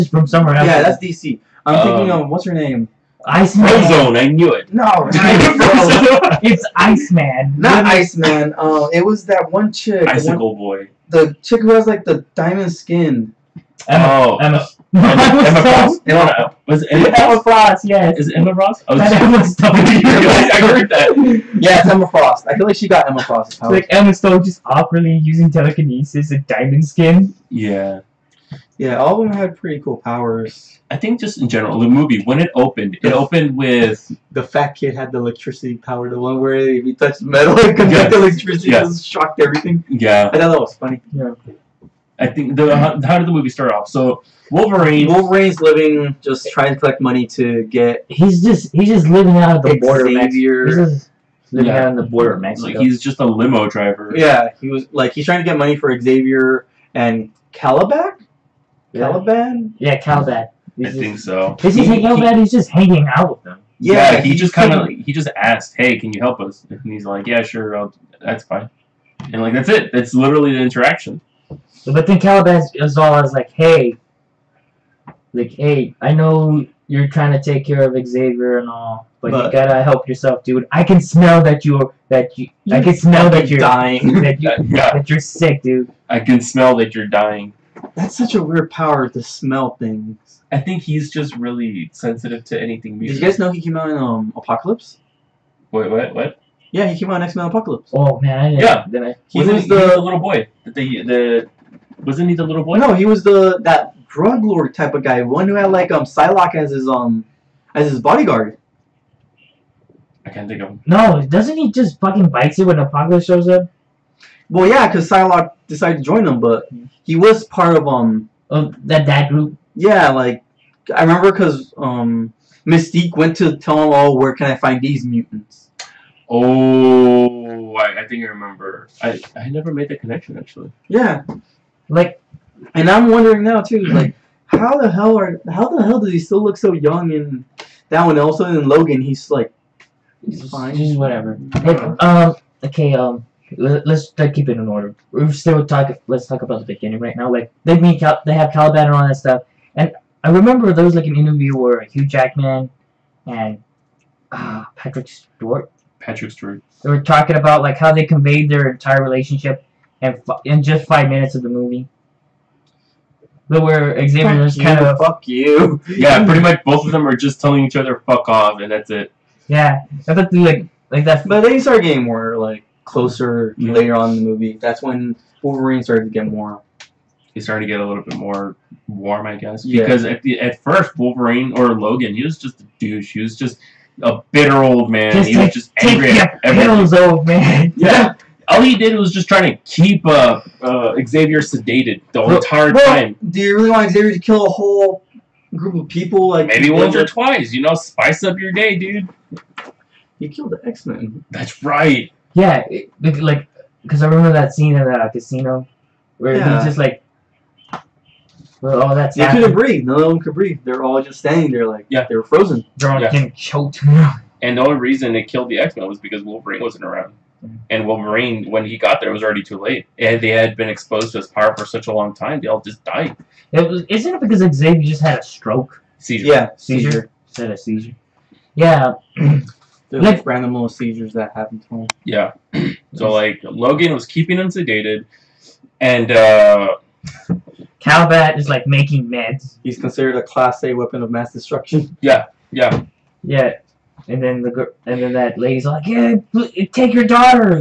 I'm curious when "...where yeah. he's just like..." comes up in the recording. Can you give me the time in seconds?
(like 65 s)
206 s.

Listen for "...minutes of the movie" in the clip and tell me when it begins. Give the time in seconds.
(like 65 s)
161 s.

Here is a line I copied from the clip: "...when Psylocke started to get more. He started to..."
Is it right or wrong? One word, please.
wrong.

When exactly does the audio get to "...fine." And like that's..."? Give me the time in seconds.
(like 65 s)
68 s.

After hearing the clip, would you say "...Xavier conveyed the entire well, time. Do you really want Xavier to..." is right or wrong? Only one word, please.
wrong.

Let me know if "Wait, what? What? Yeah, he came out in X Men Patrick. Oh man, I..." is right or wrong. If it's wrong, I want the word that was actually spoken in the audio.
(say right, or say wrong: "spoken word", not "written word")
wrong: "Apocalypse", not "Patrick".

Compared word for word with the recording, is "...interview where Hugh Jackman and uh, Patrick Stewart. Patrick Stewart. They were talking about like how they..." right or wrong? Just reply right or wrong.
right.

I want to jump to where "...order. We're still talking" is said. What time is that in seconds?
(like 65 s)
144 s.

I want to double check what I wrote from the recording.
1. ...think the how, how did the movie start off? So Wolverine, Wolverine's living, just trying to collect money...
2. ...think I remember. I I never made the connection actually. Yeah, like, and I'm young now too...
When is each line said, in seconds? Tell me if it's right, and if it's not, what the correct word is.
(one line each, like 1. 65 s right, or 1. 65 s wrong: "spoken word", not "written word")
1. 42 s right
2. 128 s wrong: "wondering", not "young".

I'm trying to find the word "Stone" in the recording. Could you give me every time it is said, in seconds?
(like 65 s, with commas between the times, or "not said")
19 s, 24 s.